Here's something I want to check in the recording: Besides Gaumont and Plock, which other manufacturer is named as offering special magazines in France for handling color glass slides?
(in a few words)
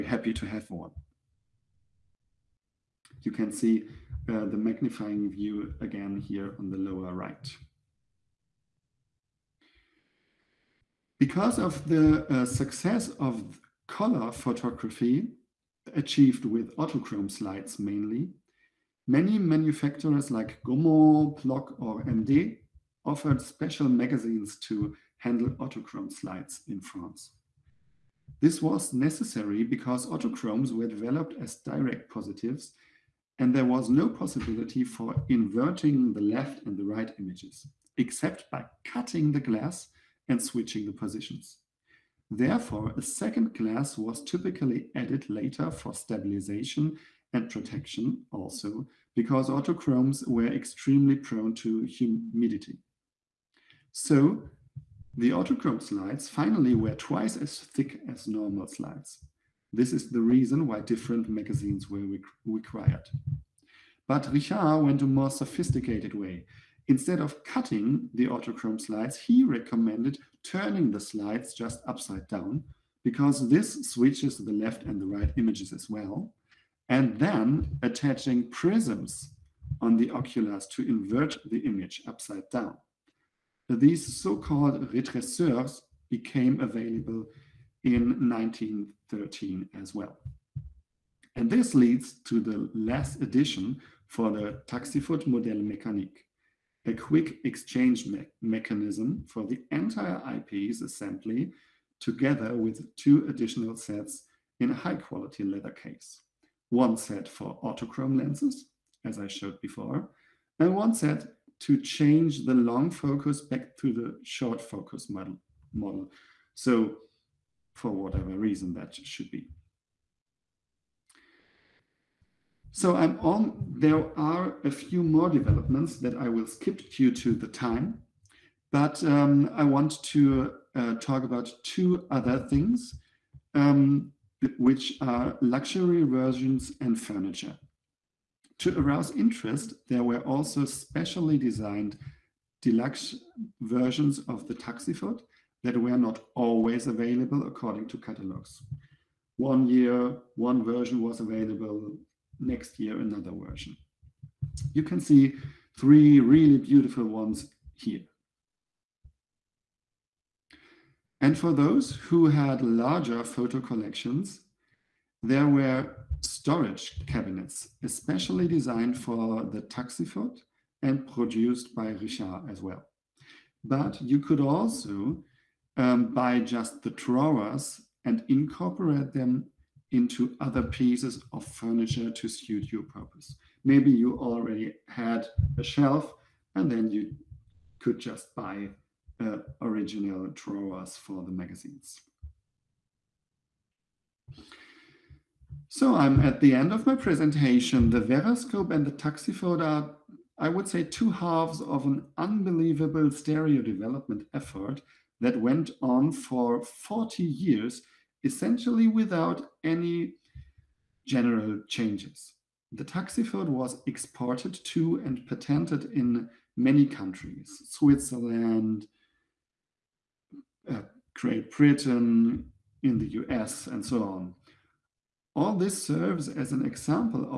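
MD.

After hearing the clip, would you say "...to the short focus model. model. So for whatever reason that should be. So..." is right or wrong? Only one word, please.
right.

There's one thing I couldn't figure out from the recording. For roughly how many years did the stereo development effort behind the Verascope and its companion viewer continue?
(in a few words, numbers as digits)
40 years.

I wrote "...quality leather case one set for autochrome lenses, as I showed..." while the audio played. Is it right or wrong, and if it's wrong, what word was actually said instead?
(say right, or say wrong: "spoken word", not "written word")
right.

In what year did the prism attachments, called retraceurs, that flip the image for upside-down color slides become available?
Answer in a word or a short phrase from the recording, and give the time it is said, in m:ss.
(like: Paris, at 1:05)
1913, at 1:28.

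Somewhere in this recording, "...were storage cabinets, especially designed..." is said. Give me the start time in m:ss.
2:45.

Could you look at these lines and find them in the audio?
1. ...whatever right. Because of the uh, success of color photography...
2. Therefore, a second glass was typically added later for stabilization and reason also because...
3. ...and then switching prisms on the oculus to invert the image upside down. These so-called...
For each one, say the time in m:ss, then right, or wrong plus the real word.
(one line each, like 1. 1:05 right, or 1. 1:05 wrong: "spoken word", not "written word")
1. 0:06 wrong: "lower", not "whatever"
2. 0:42 wrong: "protection", not "reason"
3. 1:16 wrong: "attaching", not "switching".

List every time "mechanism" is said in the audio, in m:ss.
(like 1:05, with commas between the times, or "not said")
1:38.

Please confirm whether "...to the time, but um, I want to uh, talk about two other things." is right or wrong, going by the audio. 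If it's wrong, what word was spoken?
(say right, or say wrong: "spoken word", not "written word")
right.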